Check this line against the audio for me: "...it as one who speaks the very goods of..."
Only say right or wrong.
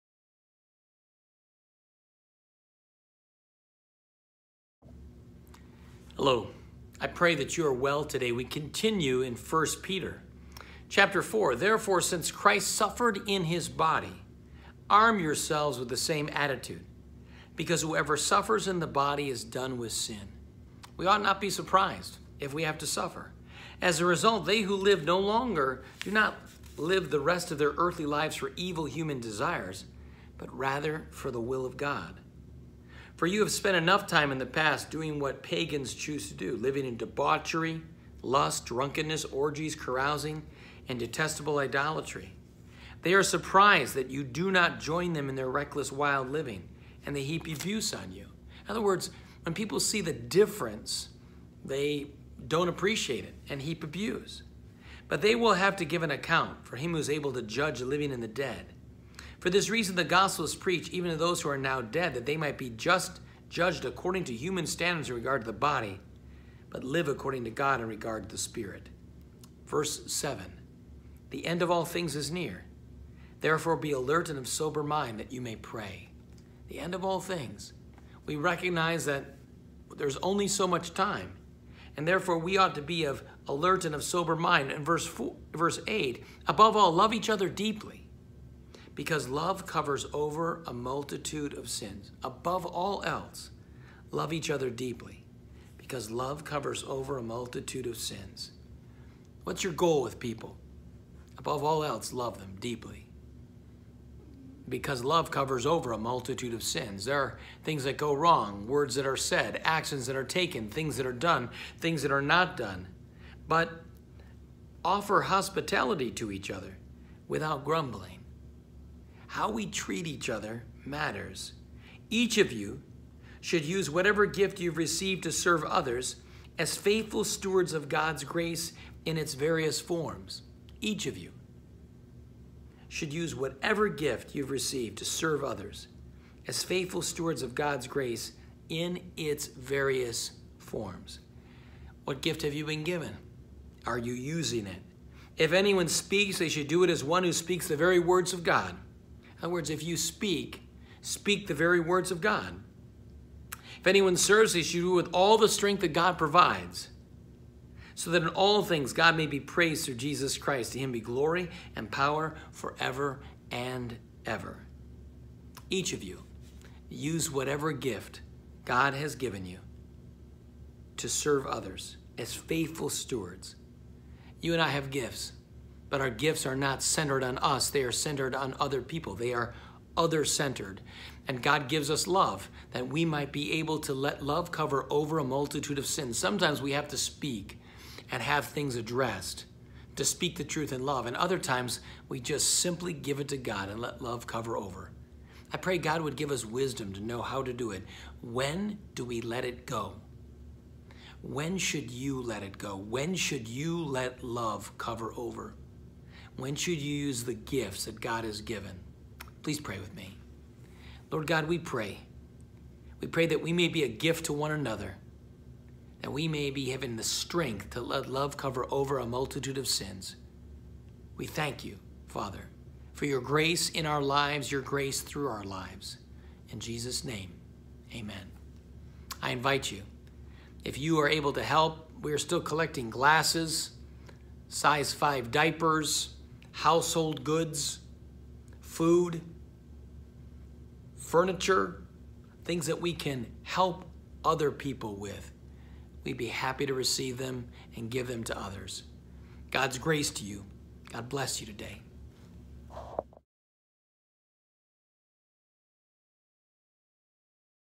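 wrong.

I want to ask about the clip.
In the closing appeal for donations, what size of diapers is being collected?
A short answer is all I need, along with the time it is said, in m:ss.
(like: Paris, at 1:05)
Size 5, at 3:54.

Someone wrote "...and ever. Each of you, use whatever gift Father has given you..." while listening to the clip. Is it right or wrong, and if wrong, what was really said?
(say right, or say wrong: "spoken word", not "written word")
wrong: "God", not "Father".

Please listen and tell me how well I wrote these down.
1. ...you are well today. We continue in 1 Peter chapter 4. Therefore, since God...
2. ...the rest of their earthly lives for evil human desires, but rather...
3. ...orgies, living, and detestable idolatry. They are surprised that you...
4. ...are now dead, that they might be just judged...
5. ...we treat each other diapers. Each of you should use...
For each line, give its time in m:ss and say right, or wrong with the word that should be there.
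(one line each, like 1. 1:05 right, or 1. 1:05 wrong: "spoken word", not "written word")
1. 0:07 wrong: "Christ", not "God"
2. 0:27 right
3. 0:39 wrong: "carousing", not "living"
4. 1:01 right
5. 1:59 wrong: "matters", not "diapers".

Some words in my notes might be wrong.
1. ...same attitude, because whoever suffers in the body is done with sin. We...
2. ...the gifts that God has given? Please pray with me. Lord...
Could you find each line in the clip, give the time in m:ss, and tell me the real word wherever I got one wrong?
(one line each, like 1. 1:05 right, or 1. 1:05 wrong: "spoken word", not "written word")
1. 0:15 right
2. 3:27 right.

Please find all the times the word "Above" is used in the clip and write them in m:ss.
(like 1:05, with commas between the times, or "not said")
1:26, 1:32, 1:41.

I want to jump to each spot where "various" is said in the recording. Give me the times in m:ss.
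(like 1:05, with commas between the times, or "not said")
2:09, 2:19.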